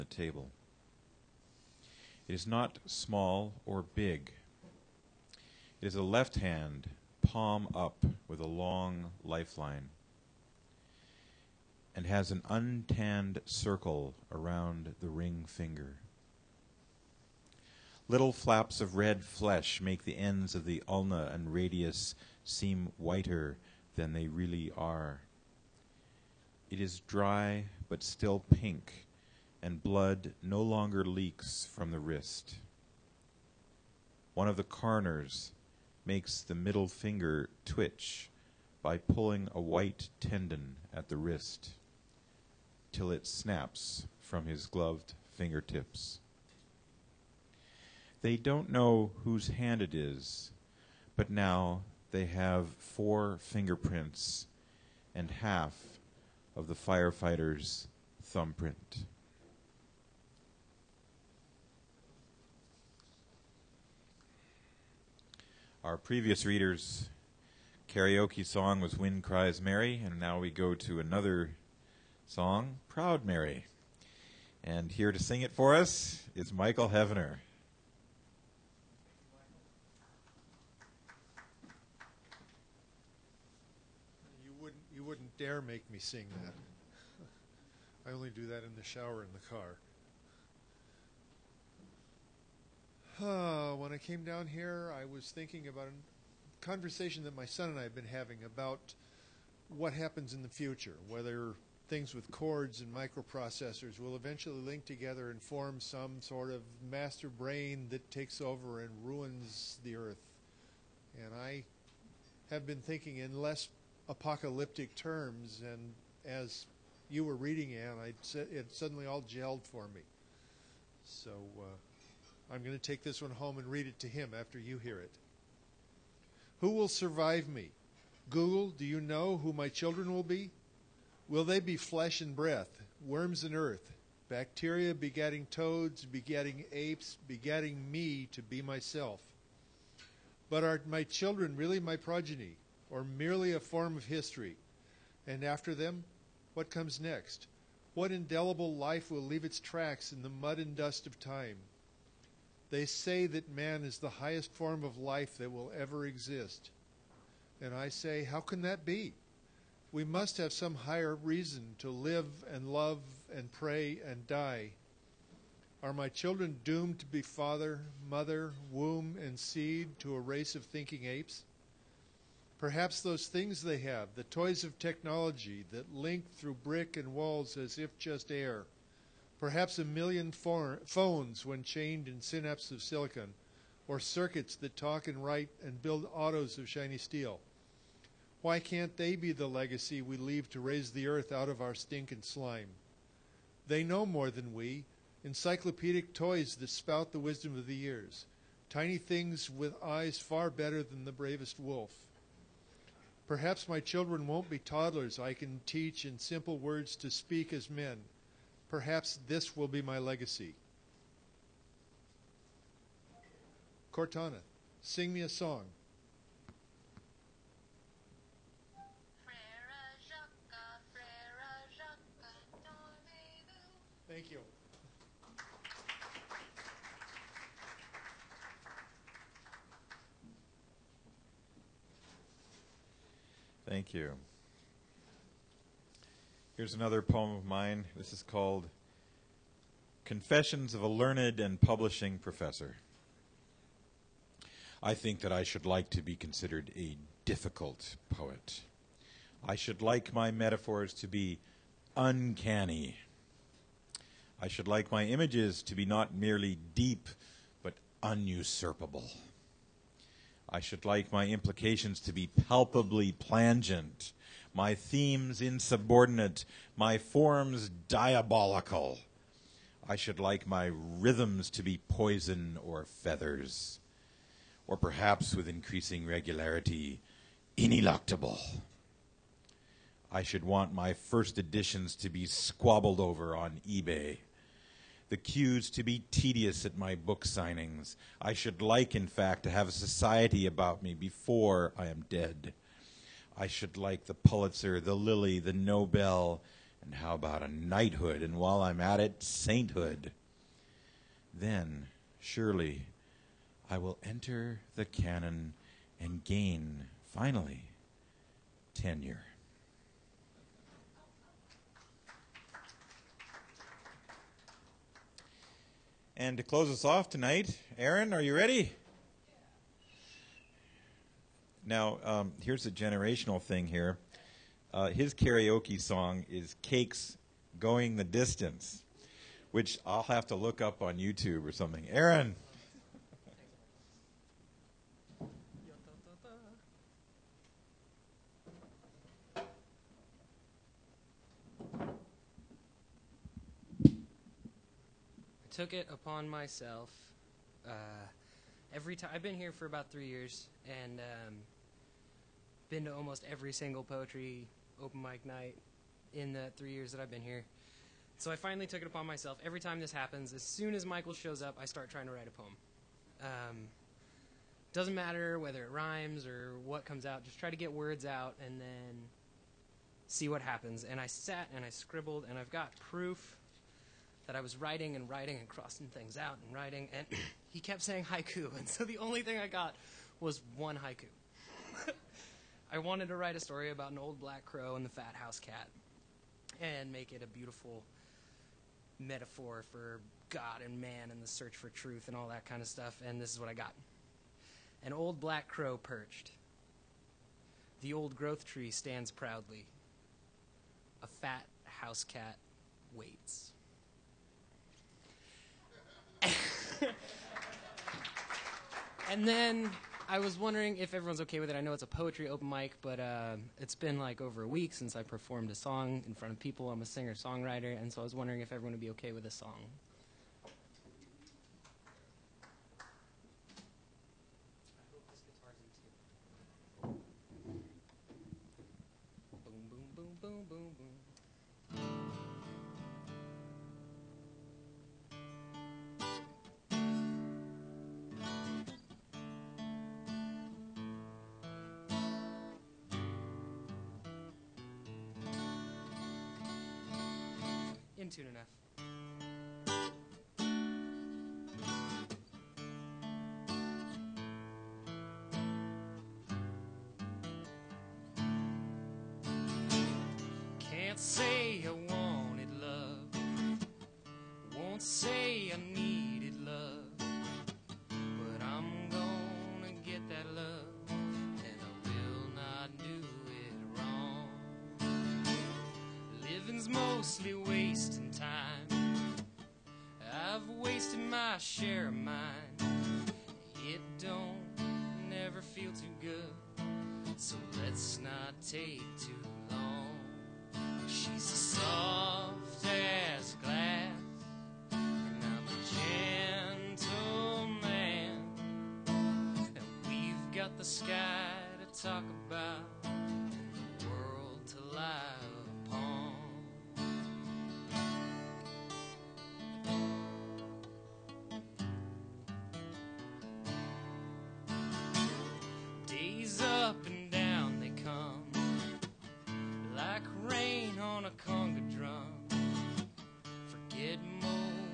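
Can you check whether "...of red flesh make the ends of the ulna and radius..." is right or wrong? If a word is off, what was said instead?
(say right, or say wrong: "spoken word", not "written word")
right.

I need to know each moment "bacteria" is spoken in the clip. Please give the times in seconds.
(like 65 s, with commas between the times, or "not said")
134 s.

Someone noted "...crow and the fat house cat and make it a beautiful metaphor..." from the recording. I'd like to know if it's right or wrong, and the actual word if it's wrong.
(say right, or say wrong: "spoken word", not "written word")
right.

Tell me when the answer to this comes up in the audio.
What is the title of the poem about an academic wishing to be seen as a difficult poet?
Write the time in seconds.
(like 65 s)
240 s.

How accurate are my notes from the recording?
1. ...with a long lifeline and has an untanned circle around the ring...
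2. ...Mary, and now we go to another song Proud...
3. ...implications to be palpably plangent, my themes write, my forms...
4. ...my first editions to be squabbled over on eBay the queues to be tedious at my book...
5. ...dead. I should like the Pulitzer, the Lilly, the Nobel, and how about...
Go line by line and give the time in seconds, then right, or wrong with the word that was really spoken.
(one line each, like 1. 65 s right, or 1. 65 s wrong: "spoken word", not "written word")
1. 8 s right
2. 69 s right
3. 261 s wrong: "insubordinate", not "write"
4. 280 s right
5. 292 s right.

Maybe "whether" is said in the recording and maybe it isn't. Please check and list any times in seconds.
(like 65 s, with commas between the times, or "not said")
101 s, 365 s.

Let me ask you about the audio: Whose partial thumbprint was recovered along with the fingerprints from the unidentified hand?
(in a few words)
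The firefighter's.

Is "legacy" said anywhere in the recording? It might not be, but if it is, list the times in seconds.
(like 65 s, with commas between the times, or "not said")
189 s, 209 s.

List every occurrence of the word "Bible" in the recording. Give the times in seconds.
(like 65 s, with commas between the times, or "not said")
not said.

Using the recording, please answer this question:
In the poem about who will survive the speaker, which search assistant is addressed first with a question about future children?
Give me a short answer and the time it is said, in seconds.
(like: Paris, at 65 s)
Google, at 128 s.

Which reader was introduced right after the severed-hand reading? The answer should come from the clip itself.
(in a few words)
Michael Hevener.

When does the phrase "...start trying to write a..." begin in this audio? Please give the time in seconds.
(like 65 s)
361 s.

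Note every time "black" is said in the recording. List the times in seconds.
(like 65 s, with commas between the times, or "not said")
384 s, 395 s.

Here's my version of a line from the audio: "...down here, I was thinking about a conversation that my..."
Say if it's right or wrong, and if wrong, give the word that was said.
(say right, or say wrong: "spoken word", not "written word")
right.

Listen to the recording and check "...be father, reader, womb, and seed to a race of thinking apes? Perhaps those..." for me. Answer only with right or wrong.
wrong.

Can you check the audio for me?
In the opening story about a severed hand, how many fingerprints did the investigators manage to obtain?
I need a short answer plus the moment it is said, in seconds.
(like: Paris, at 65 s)
4, at 52 s.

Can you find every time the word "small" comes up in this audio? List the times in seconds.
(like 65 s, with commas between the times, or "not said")
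2 s.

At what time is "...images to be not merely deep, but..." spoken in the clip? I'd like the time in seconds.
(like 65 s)
255 s.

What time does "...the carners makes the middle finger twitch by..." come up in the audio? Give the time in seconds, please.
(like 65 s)
34 s.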